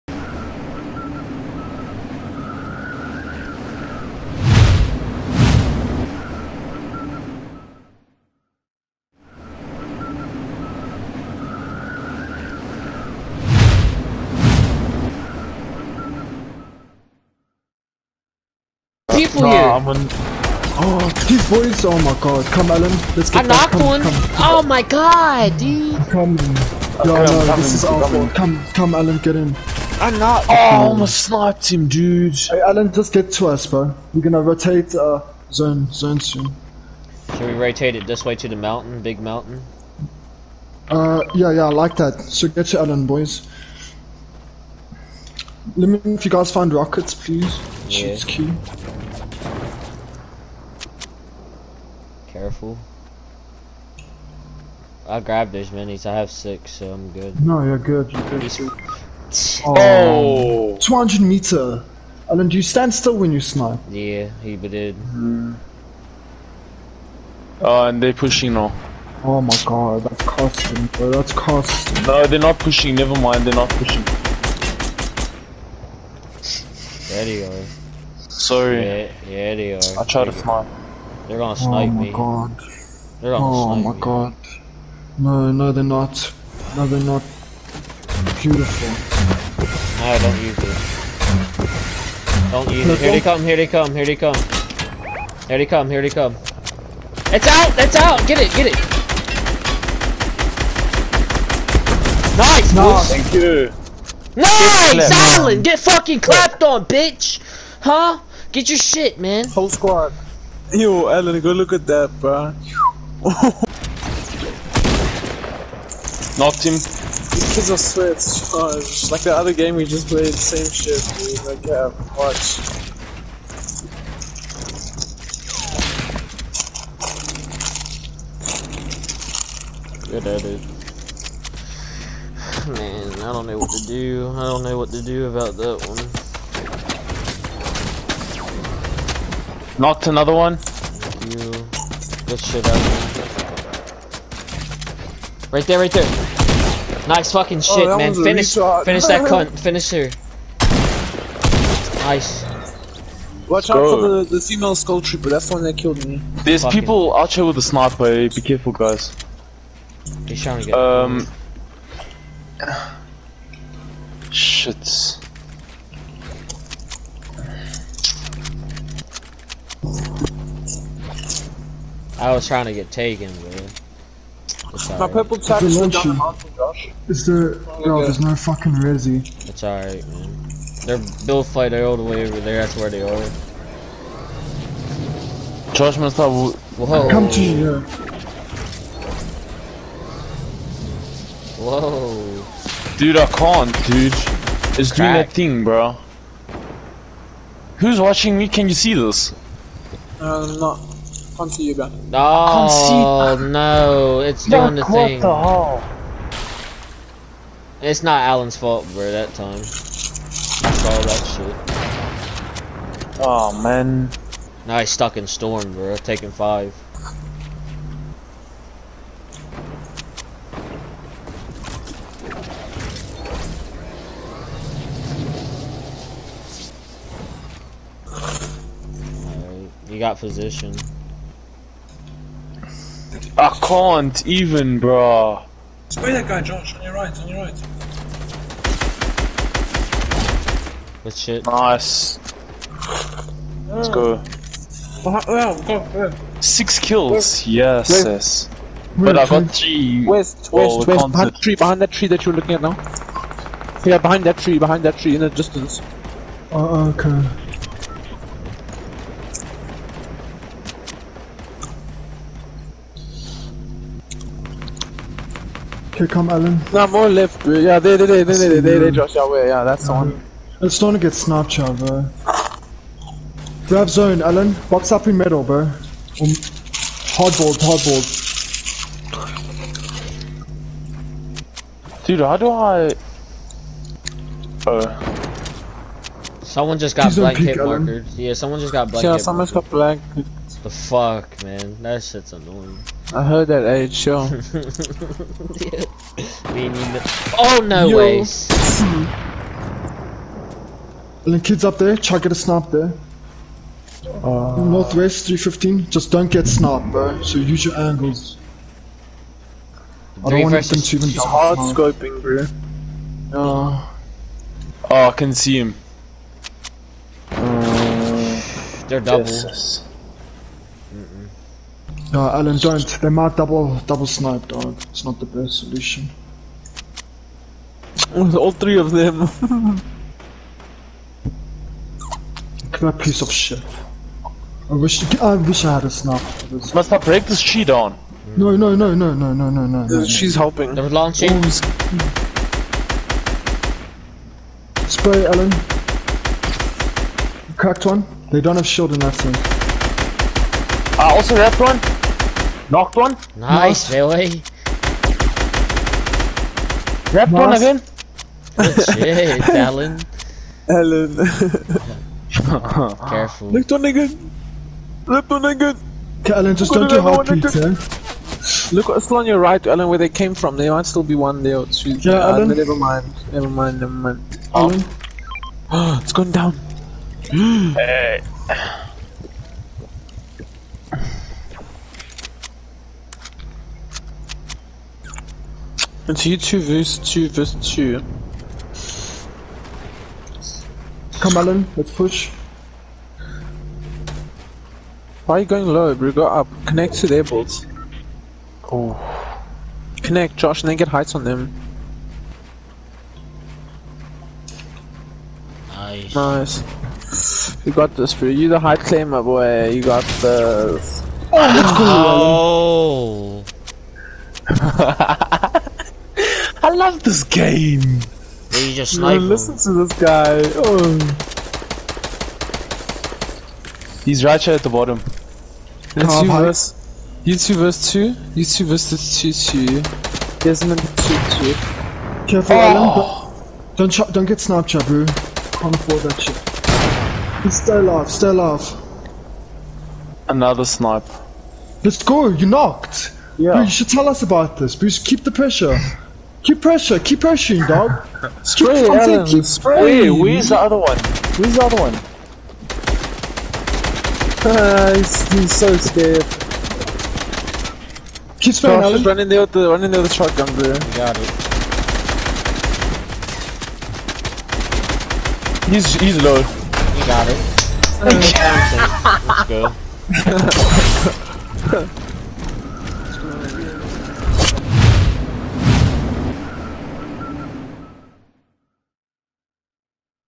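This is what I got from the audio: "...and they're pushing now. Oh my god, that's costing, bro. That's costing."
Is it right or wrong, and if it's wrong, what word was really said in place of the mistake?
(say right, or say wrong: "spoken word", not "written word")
right.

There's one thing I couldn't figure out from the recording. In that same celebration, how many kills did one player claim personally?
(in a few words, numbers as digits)
3.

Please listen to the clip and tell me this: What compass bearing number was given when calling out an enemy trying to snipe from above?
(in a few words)
315.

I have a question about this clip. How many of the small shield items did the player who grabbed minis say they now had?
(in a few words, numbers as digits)
6.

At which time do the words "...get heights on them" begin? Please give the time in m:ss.
6:40.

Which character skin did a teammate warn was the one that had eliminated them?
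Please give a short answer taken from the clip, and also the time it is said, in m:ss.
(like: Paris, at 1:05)
female skull trooper, at 2:34.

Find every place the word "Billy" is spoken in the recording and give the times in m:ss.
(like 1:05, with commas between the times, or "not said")
5:53.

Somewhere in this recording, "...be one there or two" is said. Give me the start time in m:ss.
6:11.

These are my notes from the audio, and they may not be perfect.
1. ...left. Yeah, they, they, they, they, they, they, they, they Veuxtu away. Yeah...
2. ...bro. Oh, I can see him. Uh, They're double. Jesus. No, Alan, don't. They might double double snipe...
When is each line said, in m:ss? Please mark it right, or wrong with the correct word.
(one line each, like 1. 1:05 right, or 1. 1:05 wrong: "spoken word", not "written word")
1. 4:27 wrong: "Josh", not "Veuxtu"
2. 5:12 right.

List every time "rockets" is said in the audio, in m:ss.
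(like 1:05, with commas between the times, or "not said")
0:46.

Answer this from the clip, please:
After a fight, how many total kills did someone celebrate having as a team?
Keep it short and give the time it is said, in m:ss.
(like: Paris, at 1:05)
6, at 4:06.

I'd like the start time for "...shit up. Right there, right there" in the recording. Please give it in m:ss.
2:22.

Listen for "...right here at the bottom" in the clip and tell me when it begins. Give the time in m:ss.
7:04.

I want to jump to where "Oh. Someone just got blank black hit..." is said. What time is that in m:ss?
4:44.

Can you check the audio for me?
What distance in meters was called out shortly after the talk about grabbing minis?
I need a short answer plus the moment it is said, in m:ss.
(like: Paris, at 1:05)
200, at 1:00.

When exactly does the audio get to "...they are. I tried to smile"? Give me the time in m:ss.
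1:19.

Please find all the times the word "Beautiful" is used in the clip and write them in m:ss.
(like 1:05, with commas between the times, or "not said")
1:28.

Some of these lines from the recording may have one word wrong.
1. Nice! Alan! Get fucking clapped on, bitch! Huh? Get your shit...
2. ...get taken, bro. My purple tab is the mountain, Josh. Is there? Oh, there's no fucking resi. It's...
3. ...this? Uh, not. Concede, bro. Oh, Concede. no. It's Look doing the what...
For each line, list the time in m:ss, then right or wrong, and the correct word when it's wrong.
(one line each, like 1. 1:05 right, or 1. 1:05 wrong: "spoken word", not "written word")
1. 1:44 right
2. 2:52 right
3. 3:18 right.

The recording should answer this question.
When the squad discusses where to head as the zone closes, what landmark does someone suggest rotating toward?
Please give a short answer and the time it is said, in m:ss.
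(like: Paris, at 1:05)
big mountain, at 0:39.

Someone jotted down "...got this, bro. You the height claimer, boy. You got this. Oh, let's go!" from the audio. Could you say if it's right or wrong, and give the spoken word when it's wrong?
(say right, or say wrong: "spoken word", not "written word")
right.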